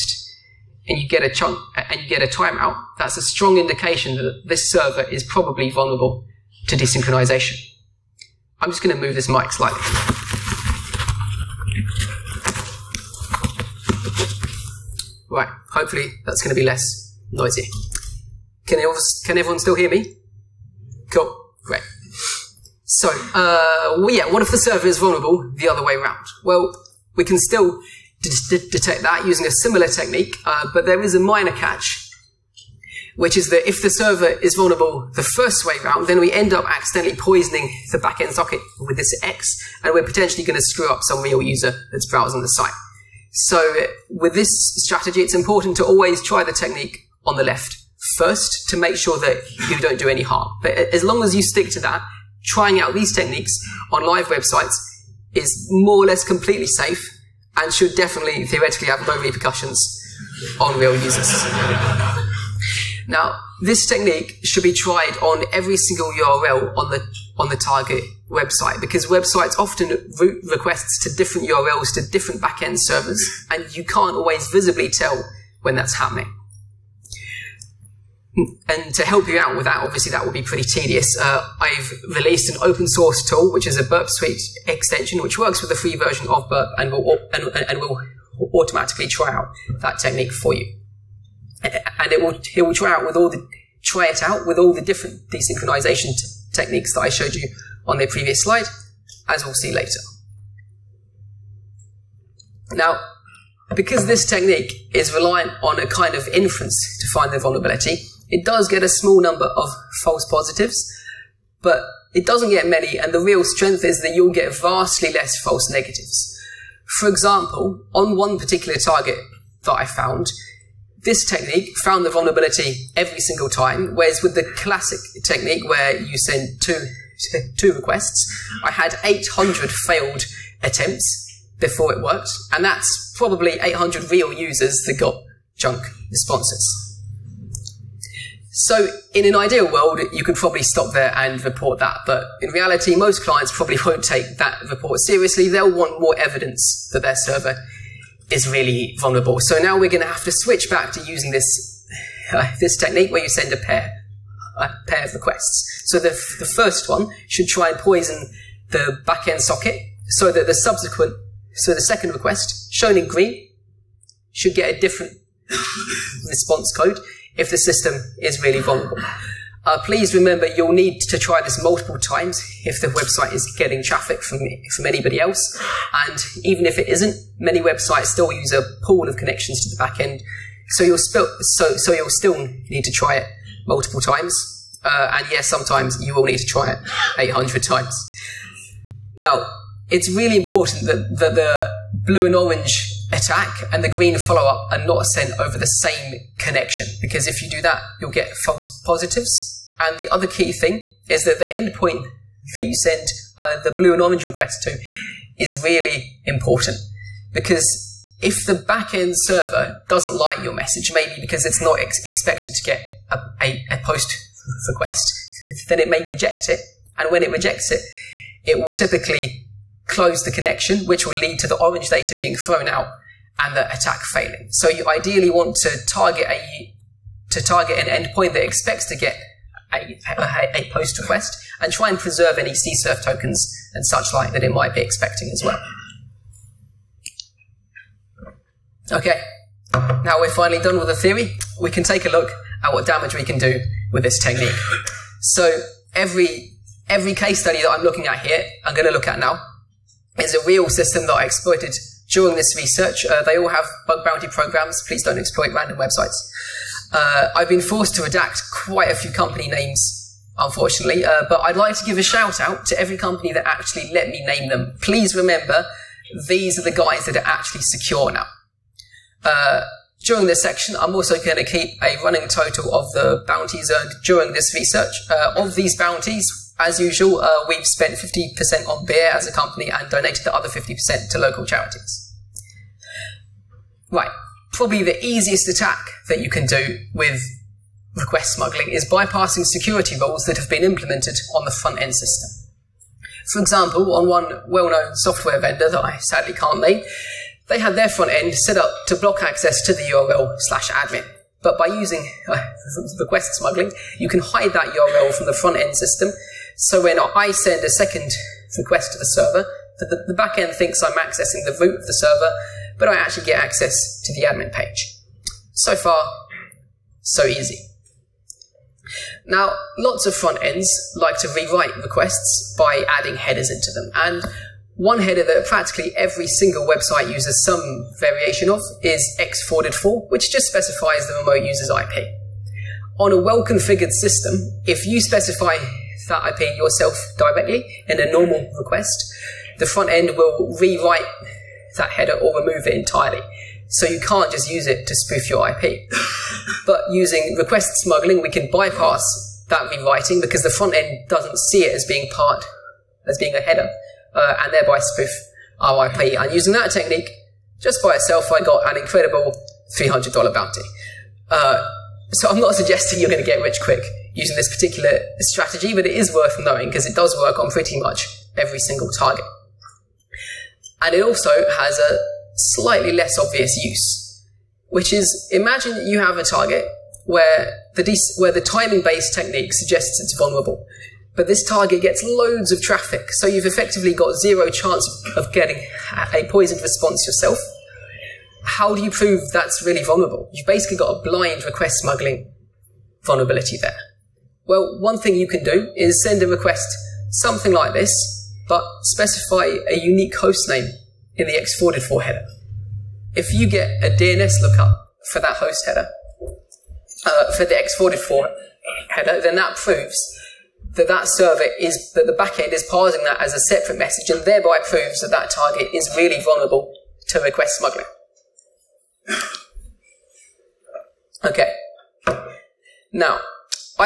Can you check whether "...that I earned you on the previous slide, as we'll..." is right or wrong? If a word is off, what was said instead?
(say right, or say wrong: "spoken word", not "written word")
wrong: "showed", not "earned".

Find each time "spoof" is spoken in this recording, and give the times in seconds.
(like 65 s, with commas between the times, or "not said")
344 s, 354 s.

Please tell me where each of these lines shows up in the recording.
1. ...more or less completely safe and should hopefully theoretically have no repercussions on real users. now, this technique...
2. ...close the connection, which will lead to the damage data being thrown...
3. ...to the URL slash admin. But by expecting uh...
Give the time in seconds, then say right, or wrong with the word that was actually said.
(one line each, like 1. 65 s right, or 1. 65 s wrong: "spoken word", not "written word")
1. 55 s wrong: "definitely", not "hopefully"
2. 219 s wrong: "orange", not "damage"
3. 299 s wrong: "using", not "expecting".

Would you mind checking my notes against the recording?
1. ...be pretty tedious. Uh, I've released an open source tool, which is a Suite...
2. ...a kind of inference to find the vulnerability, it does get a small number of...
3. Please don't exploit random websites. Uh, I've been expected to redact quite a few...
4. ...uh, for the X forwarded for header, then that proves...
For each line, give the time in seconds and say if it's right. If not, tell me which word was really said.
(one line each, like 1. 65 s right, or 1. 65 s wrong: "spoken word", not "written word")
1. 80 s wrong: "Burp", not "Suite"
2. 105 s right
3. 254 s wrong: "forced", not "expected"
4. 407 s right.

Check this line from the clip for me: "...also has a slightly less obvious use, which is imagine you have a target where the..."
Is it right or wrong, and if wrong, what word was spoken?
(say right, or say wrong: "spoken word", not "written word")
right.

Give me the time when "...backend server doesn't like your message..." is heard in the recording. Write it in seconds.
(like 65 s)
208 s.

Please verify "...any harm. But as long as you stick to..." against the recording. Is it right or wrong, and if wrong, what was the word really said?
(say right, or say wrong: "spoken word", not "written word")
right.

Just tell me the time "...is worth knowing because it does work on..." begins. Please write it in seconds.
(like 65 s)
365 s.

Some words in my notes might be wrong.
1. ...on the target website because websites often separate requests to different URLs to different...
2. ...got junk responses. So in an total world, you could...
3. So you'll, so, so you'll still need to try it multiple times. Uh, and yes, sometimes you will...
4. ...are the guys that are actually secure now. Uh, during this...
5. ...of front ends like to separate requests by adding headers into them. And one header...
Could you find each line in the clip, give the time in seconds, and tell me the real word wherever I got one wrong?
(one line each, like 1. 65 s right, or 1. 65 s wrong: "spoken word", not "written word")
1. 67 s wrong: "route", not "separate"
2. 134 s wrong: "ideal", not "total"
3. 180 s right
4. 266 s right
5. 320 s wrong: "rewrite", not "separate".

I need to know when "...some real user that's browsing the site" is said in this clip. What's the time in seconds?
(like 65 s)
41 s.